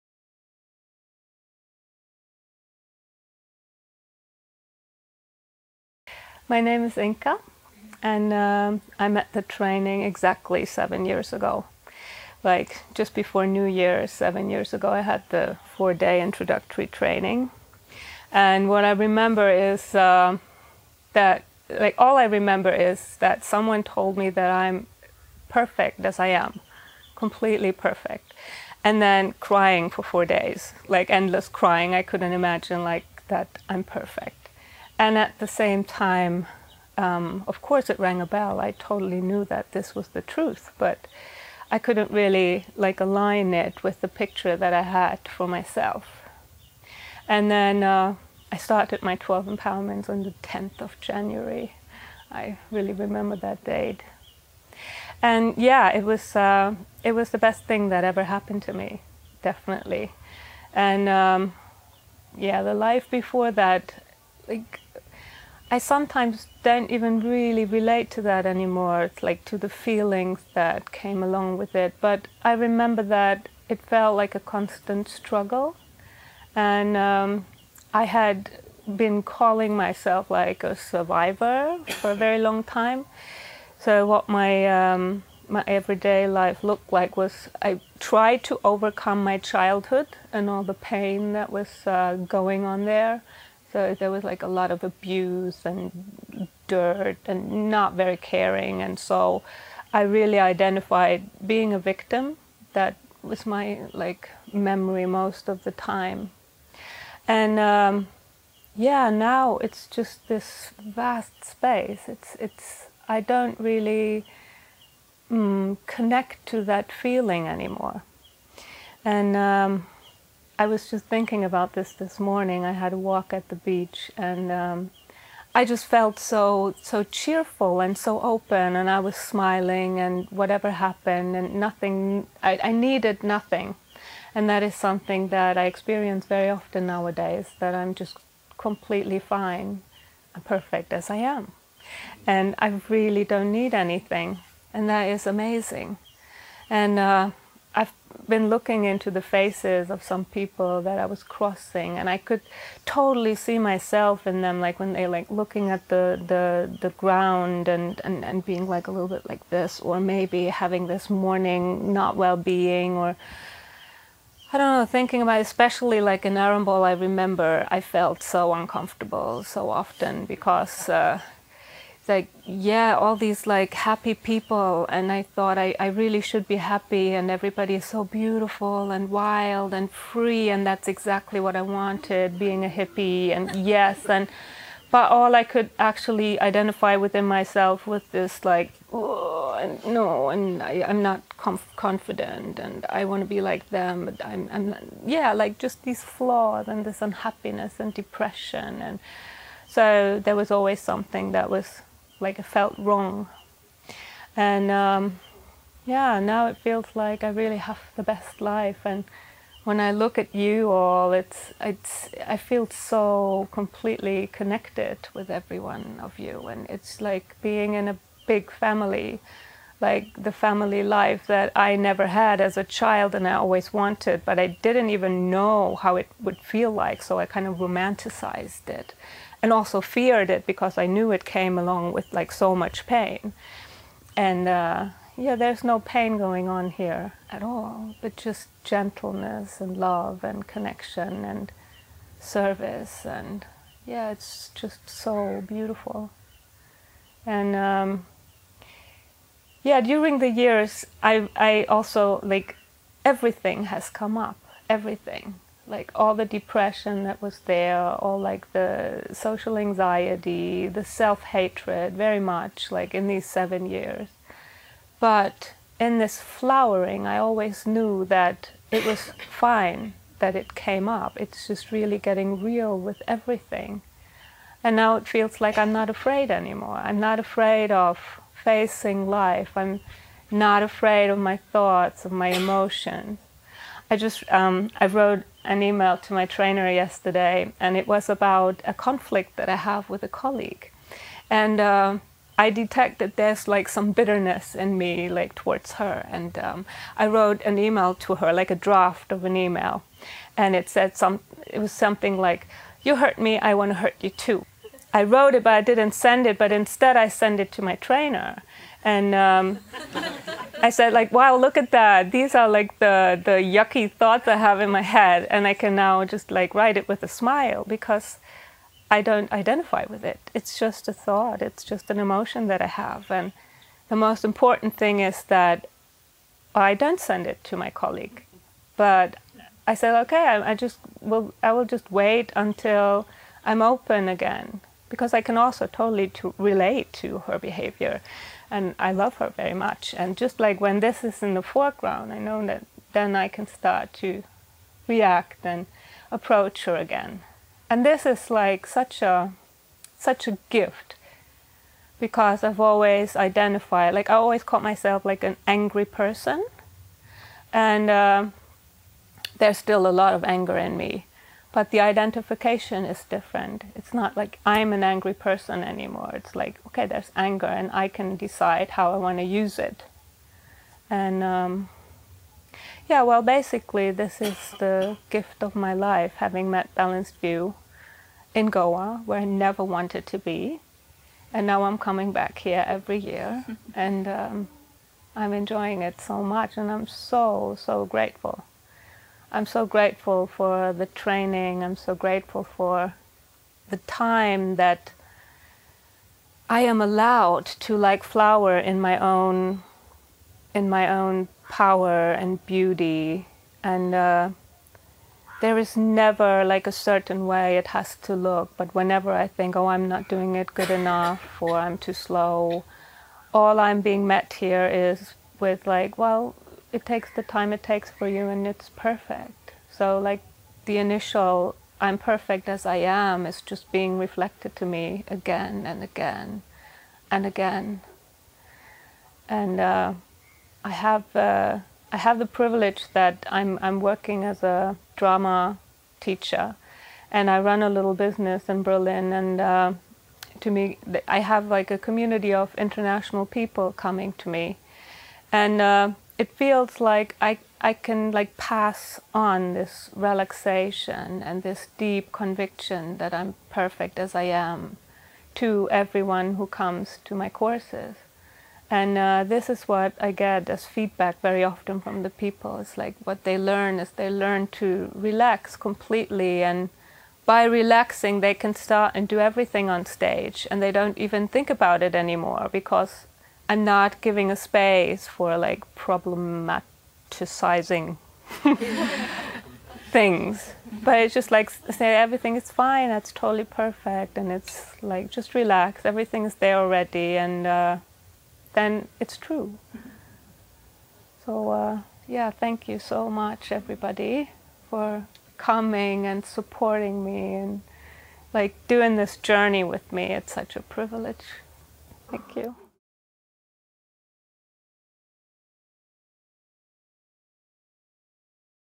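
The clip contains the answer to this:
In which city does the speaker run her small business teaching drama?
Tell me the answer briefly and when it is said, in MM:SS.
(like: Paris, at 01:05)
Berlin, at 07:18.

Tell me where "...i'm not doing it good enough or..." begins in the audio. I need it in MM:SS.
06:49.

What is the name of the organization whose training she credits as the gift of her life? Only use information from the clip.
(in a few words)
Balanced View.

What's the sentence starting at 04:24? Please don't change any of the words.
But in this flowering, I always knew that it was fine that it came up.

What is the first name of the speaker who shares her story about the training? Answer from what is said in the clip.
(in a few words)
Inka.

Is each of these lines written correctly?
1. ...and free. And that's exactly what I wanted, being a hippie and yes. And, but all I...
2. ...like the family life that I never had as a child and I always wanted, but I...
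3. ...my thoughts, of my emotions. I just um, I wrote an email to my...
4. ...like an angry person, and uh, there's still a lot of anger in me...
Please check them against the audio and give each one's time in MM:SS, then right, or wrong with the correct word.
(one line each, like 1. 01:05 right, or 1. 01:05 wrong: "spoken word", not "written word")
1. 02:59 right
2. 03:39 right
3. 04:41 right
4. 05:55 right.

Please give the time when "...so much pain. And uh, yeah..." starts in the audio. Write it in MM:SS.
03:52.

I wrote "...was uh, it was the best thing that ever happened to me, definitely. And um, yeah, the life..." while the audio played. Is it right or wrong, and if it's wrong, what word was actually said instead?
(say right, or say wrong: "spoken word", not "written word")
right.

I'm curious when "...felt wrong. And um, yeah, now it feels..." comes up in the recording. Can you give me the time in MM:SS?
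03:22.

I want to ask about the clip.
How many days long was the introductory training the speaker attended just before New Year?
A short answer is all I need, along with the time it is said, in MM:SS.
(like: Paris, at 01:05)
4, at 00:15.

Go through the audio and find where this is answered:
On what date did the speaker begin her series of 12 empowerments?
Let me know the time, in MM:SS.
00:50.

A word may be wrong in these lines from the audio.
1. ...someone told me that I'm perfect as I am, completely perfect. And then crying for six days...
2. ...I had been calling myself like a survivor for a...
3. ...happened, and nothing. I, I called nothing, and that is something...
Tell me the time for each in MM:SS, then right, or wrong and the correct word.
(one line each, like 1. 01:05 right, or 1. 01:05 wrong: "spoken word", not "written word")
1. 00:23 wrong: "four", not "six"
2. 01:17 right
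3. 02:10 wrong: "needed", not "called".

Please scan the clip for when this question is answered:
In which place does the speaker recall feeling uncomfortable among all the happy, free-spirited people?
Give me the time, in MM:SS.
02:46.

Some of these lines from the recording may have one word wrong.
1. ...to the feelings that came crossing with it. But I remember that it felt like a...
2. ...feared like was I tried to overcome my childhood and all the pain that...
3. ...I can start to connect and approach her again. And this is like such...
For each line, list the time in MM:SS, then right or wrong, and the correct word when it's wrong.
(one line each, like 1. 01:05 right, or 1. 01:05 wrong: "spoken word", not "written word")
1. 01:09 wrong: "along", not "crossing"
2. 01:26 wrong: "looked", not "feared"
3. 05:43 wrong: "react", not "connect".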